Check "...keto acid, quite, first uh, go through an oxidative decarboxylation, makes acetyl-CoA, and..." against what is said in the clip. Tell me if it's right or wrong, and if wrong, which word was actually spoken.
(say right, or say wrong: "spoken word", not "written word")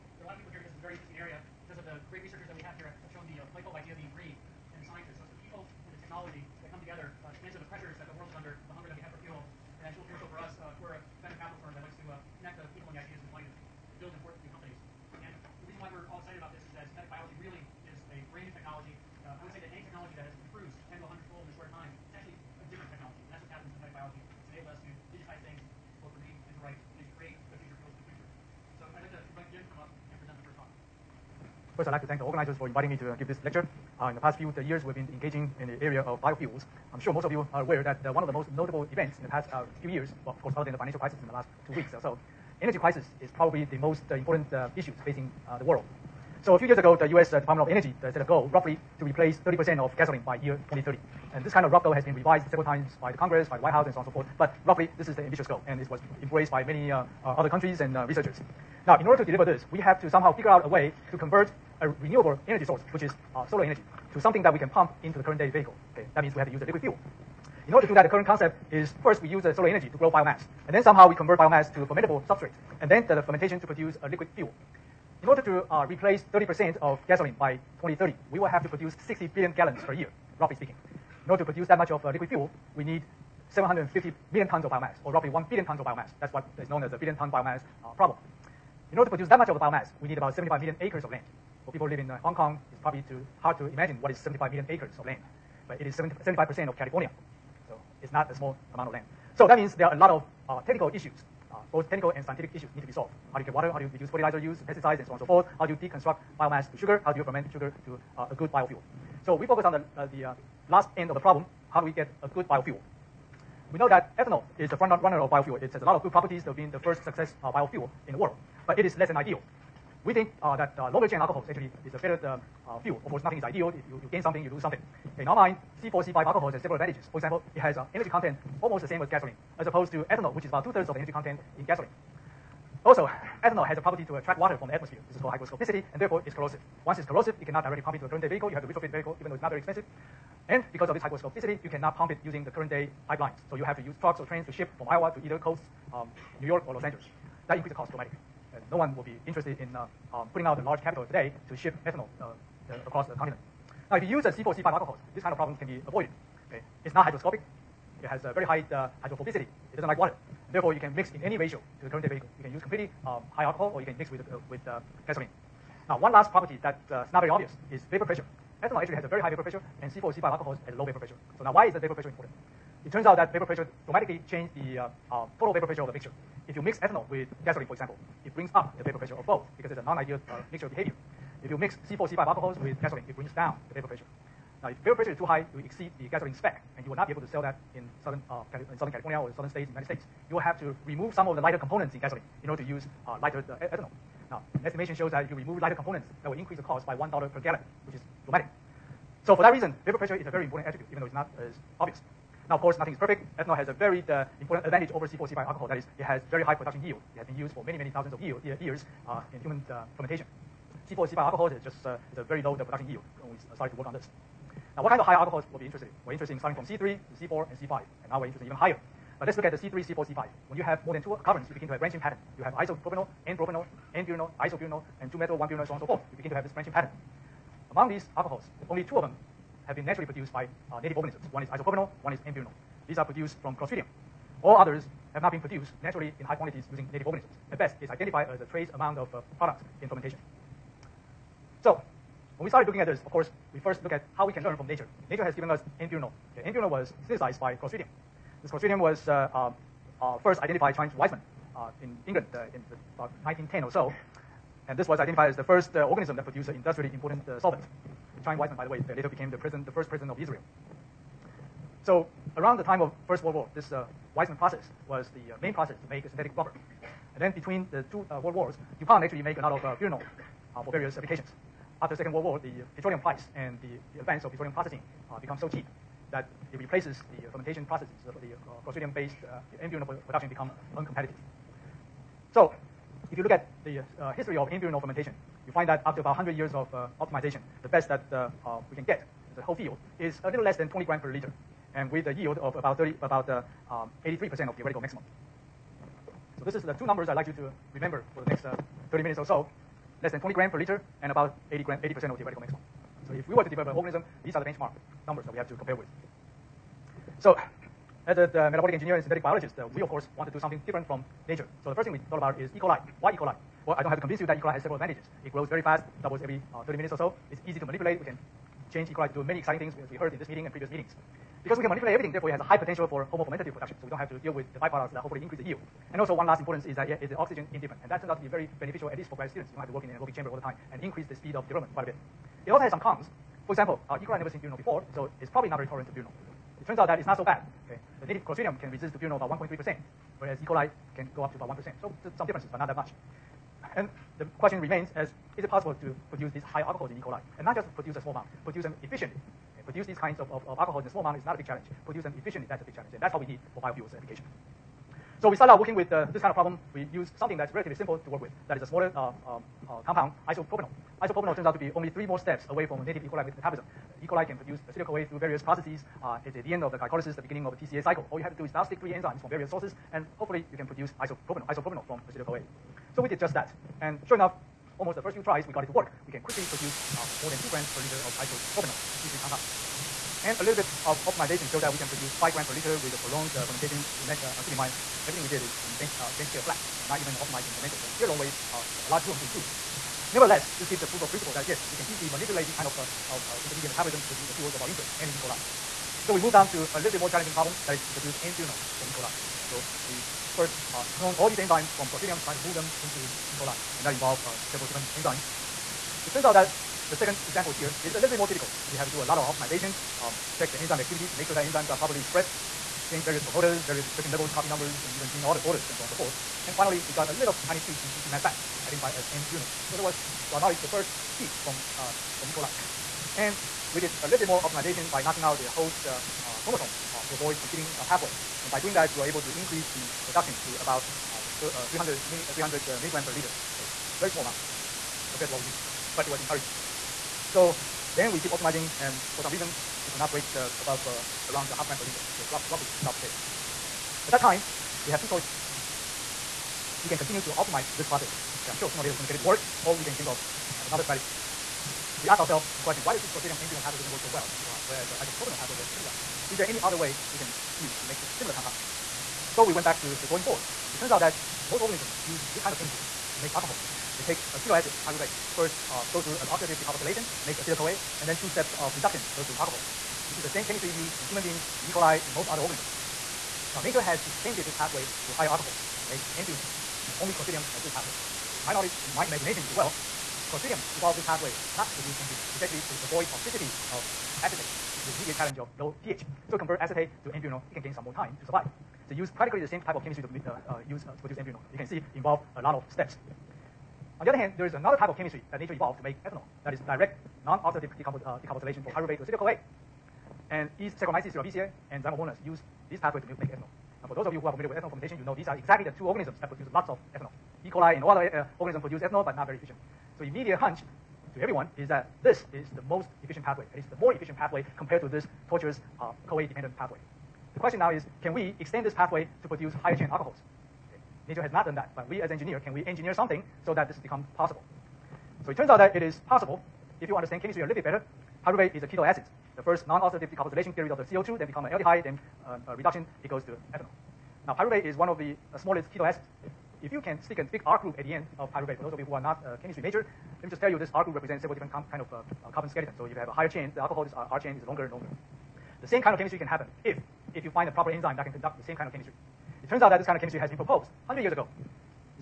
wrong: "pyruvate", not "quite".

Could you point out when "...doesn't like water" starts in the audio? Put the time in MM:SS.
02:39.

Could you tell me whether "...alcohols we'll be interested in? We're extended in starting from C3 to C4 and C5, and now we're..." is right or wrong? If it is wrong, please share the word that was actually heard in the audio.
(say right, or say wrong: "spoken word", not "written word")
wrong: "interested", not "extended".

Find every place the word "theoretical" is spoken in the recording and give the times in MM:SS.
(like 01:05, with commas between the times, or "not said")
04:54, 05:02.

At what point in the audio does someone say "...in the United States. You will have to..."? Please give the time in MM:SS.
03:09.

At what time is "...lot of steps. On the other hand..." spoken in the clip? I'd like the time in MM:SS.
08:12.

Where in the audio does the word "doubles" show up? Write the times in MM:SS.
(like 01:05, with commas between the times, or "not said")
05:16.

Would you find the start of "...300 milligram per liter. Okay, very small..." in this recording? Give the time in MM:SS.
07:12.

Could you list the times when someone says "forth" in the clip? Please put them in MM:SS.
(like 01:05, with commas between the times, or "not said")
00:54, 01:45, 03:45, 06:55.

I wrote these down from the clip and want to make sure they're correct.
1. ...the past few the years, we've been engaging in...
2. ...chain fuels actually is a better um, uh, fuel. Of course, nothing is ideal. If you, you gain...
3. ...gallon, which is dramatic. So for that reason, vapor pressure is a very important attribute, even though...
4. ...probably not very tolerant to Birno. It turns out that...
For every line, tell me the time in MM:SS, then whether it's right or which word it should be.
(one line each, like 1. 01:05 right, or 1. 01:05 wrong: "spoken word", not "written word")
1. 00:34 right
2. 02:01 wrong: "alcohols", not "fuels"
3. 03:17 right
4. 05:35 right.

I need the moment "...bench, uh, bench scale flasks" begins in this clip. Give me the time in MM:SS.
06:25.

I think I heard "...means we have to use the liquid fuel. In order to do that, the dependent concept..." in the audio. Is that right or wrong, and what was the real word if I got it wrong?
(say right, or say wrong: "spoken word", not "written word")
wrong: "current", not "dependent".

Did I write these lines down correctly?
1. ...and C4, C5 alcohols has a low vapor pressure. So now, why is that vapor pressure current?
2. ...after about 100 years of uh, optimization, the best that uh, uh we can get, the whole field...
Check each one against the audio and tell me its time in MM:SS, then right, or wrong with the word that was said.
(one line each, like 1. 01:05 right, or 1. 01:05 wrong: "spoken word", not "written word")
1. 02:49 wrong: "important", not "current"
2. 04:45 right.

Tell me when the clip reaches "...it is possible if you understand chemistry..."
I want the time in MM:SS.
08:45.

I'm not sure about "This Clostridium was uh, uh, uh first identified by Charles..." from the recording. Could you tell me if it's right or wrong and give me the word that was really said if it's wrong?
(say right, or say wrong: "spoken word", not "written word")
right.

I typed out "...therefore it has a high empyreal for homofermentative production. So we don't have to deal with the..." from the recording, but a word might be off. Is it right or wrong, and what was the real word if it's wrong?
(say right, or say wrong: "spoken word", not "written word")
wrong: "potential", not "empyreal".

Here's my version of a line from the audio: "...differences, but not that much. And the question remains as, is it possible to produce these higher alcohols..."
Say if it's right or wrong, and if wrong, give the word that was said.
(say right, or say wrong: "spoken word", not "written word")
right.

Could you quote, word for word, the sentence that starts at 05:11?
So the first thing we thought about is E.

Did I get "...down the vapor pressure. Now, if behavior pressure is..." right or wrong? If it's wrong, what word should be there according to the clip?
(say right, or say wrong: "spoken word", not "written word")
wrong: "vapor", not "behavior".